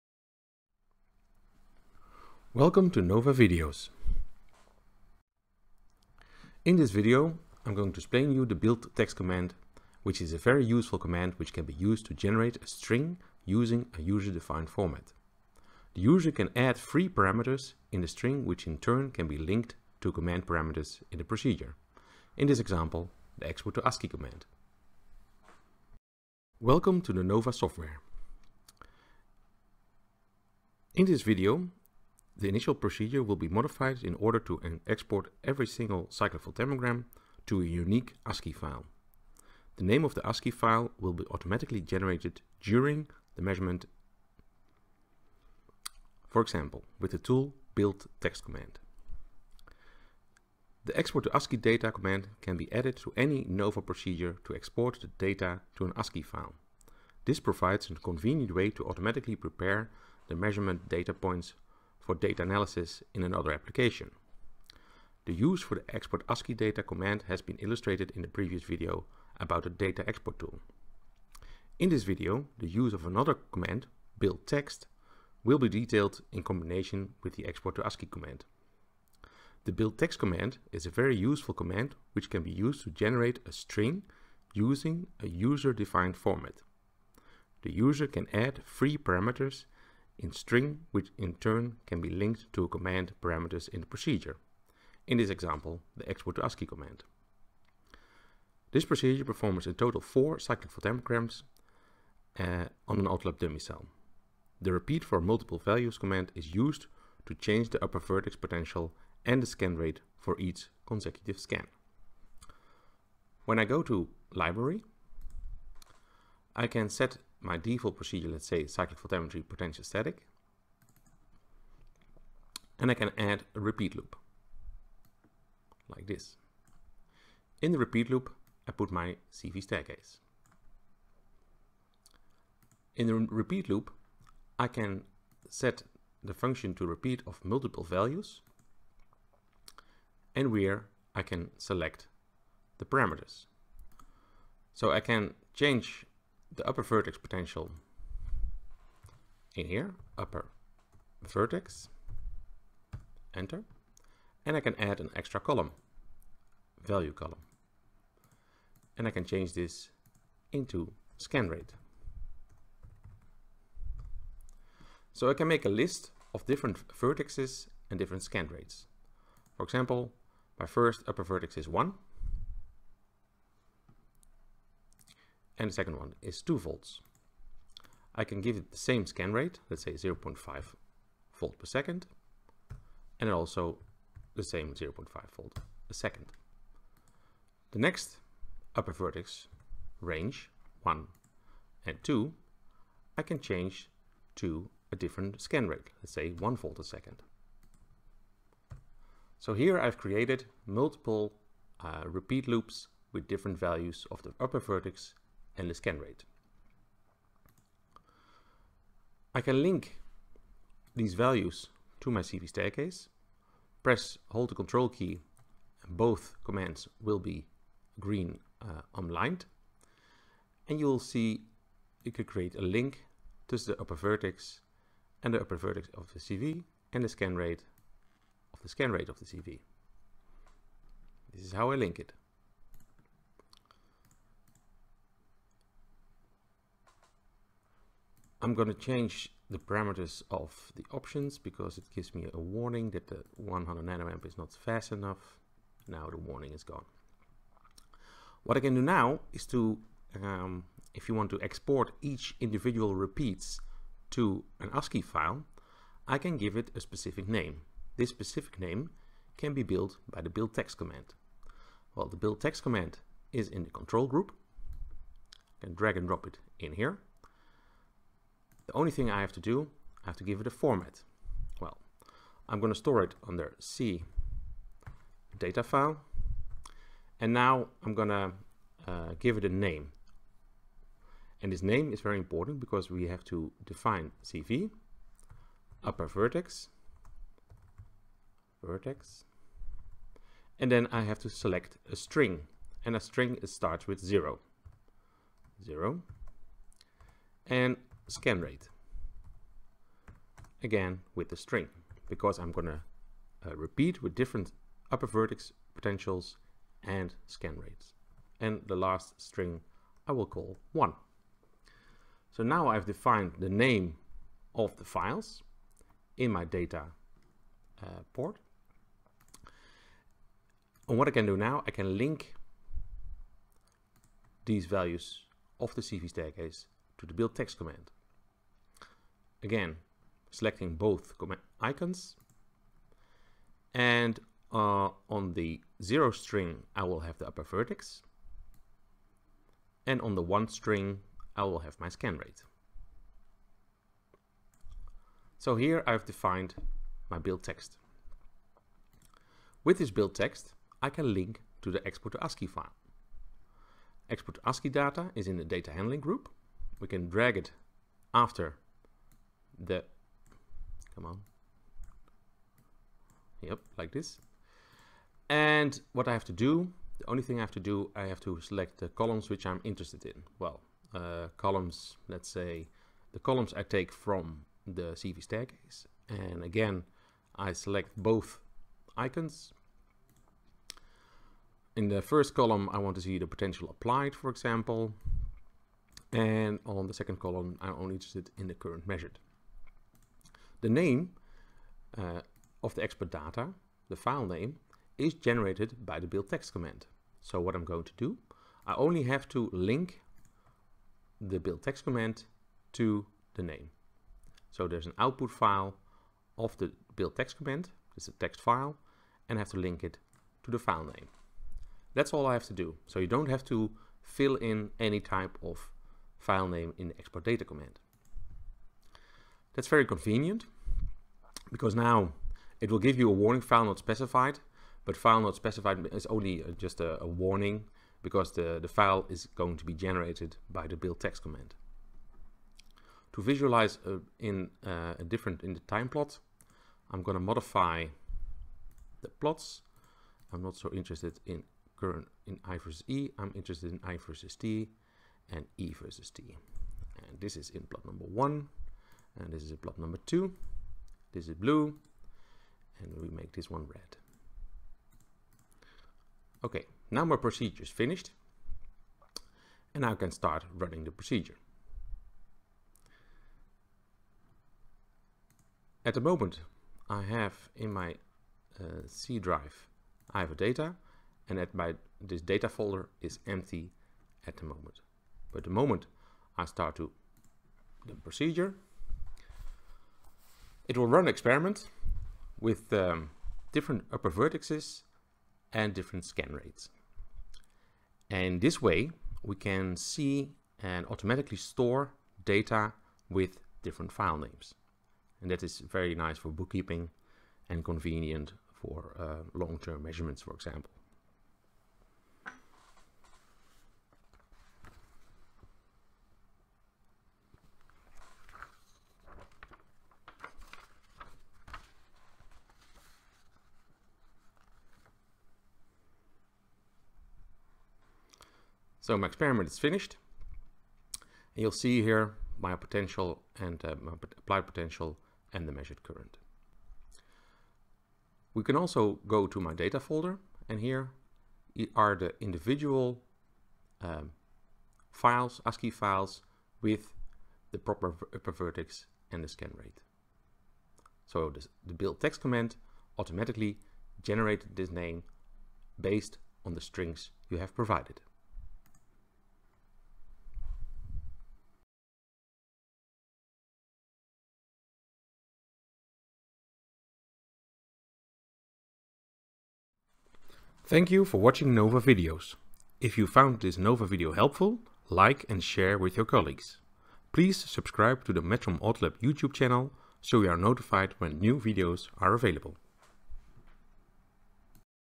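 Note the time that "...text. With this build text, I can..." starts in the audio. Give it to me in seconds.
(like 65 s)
347 s.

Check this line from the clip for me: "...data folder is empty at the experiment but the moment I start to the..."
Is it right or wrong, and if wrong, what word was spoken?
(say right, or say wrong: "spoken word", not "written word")
wrong: "moment", not "experiment".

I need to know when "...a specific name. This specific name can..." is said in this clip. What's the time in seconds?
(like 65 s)
256 s.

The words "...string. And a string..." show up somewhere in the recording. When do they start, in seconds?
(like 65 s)
291 s.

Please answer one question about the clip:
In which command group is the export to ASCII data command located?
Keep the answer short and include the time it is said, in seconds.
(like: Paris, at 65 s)
data handling, at 355 s.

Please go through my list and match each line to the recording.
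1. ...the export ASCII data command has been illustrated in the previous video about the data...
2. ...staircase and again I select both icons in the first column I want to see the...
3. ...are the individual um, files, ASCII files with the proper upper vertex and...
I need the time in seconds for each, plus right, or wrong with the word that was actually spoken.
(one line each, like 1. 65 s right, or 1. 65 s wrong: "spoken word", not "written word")
1. 65 s right
2. 375 s right
3. 531 s right.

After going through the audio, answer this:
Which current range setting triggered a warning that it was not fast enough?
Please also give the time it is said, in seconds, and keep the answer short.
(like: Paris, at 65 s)
100 nanoamp, at 243 s.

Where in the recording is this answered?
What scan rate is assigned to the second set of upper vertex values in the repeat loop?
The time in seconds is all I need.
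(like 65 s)
196 s.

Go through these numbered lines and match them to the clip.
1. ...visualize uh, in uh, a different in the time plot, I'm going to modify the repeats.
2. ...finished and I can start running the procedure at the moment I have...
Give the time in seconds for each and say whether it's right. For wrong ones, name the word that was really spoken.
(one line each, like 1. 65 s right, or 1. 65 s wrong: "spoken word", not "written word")
1. 433 s wrong: "plots", not "repeats"
2. 457 s right.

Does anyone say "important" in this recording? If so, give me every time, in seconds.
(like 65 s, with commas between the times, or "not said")
282 s.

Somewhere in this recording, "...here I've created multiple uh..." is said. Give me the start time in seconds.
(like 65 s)
199 s.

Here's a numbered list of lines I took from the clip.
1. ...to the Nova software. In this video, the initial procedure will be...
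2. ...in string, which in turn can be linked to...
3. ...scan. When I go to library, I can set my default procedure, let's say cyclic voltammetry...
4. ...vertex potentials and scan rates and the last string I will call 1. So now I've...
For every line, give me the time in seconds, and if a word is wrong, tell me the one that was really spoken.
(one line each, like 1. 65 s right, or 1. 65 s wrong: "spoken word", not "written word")
1. 27 s right
2. 90 s right
3. 111 s right
4. 305 s right.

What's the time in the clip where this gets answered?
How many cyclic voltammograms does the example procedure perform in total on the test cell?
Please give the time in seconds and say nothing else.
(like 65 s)
100 s.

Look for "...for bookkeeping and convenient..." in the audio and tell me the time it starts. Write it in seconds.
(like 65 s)
496 s.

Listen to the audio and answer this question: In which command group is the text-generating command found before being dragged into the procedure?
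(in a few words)
control group.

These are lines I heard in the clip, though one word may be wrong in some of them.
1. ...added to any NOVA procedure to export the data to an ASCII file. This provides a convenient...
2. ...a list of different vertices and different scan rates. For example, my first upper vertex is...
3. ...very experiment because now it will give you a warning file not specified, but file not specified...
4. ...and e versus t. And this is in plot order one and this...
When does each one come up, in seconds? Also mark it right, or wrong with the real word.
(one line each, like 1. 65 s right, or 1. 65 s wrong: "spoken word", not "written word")
1. 52 s right
2. 165 s right
3. 419 s wrong: "convenient", not "experiment"
4. 445 s wrong: "number", not "order".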